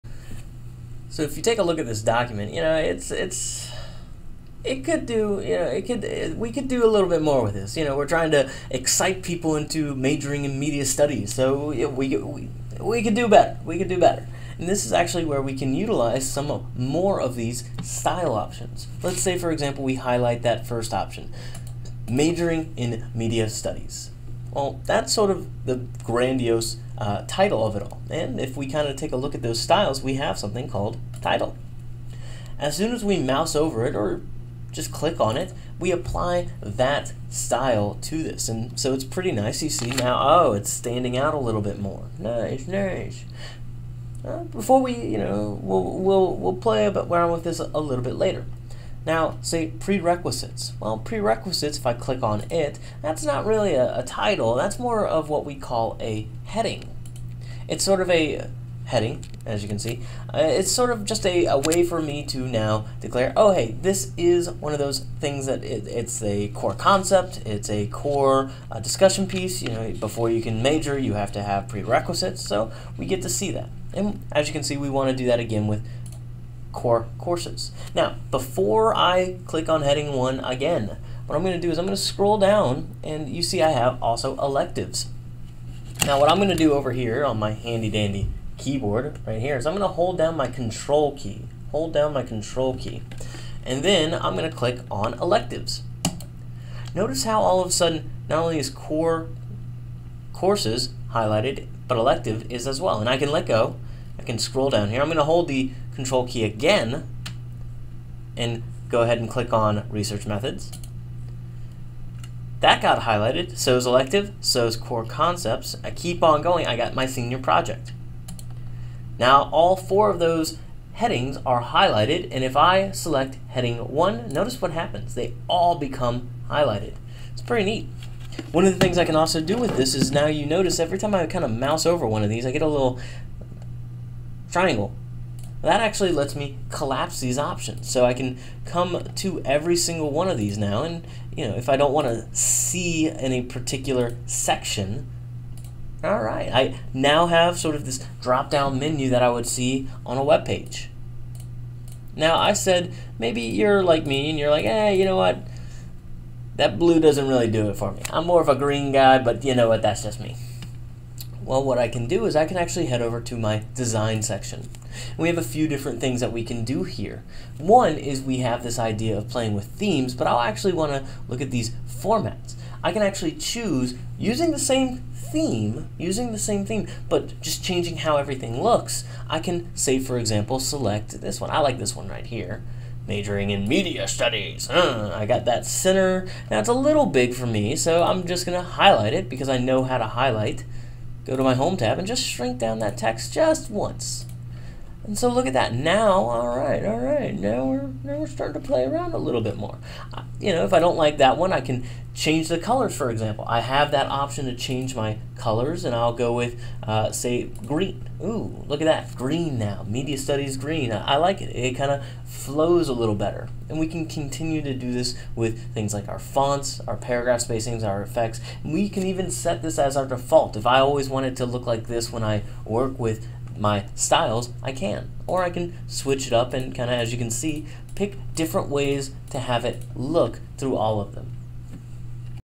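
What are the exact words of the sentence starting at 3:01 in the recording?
I like this one right here majoring in media studies.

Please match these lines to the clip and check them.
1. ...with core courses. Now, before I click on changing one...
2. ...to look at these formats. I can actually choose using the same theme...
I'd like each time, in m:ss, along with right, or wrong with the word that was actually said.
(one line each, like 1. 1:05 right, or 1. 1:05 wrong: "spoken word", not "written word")
1. 1:15 wrong: "heading", not "changing"
2. 2:50 right.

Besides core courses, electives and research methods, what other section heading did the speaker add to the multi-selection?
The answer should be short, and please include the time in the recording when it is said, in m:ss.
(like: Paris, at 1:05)
Senior project, at 1:57.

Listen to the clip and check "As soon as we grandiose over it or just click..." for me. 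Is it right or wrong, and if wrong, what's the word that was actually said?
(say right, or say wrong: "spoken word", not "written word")
wrong: "mouse", not "grandiose".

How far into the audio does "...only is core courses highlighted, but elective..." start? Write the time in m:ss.
1:38.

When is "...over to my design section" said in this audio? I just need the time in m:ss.
2:43.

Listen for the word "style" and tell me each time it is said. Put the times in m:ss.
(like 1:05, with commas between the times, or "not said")
0:17, 0:29, 0:37, 3:43.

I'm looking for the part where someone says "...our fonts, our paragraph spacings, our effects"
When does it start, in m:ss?
3:36.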